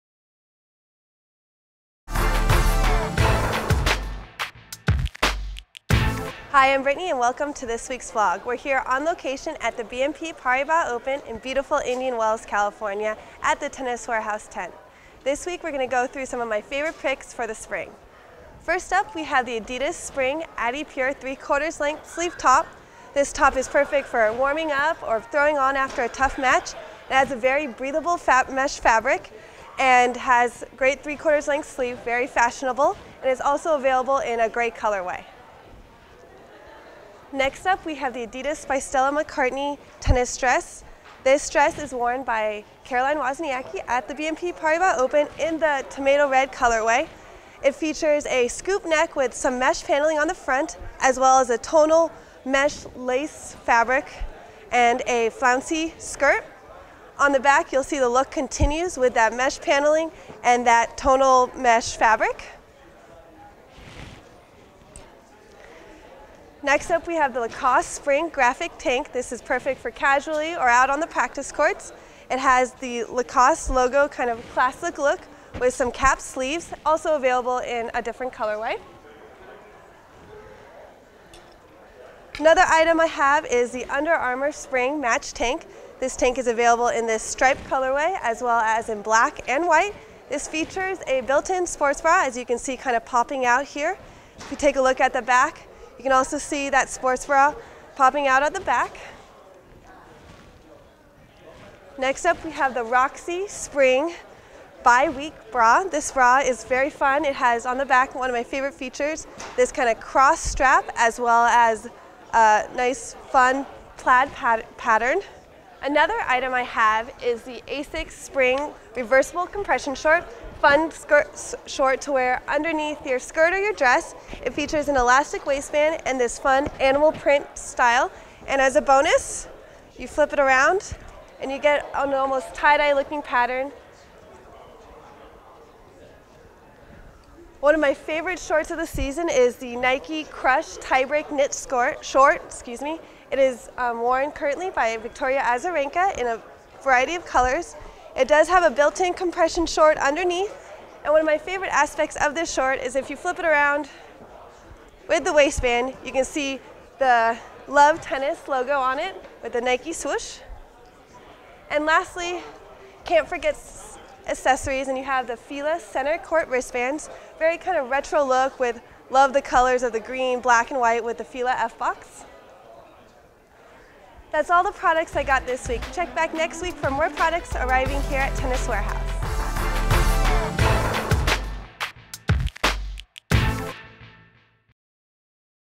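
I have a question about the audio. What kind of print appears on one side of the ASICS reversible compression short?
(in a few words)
animal print.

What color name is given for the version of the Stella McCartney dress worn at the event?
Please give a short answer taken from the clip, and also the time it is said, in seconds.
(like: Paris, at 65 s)
tomato red, at 45 s.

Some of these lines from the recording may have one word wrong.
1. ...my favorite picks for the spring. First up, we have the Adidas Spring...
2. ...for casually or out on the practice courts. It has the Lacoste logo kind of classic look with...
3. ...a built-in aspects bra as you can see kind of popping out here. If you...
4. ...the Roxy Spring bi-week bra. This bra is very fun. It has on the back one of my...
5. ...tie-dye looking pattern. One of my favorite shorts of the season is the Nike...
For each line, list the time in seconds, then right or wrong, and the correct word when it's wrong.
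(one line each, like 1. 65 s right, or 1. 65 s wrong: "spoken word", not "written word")
1. 16 s right
2. 69 s right
3. 91 s wrong: "sports", not "aspects"
4. 102 s right
5. 132 s right.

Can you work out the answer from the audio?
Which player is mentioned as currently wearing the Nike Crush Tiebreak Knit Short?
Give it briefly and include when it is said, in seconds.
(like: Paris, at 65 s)
Victoria Azarenka, at 144 s.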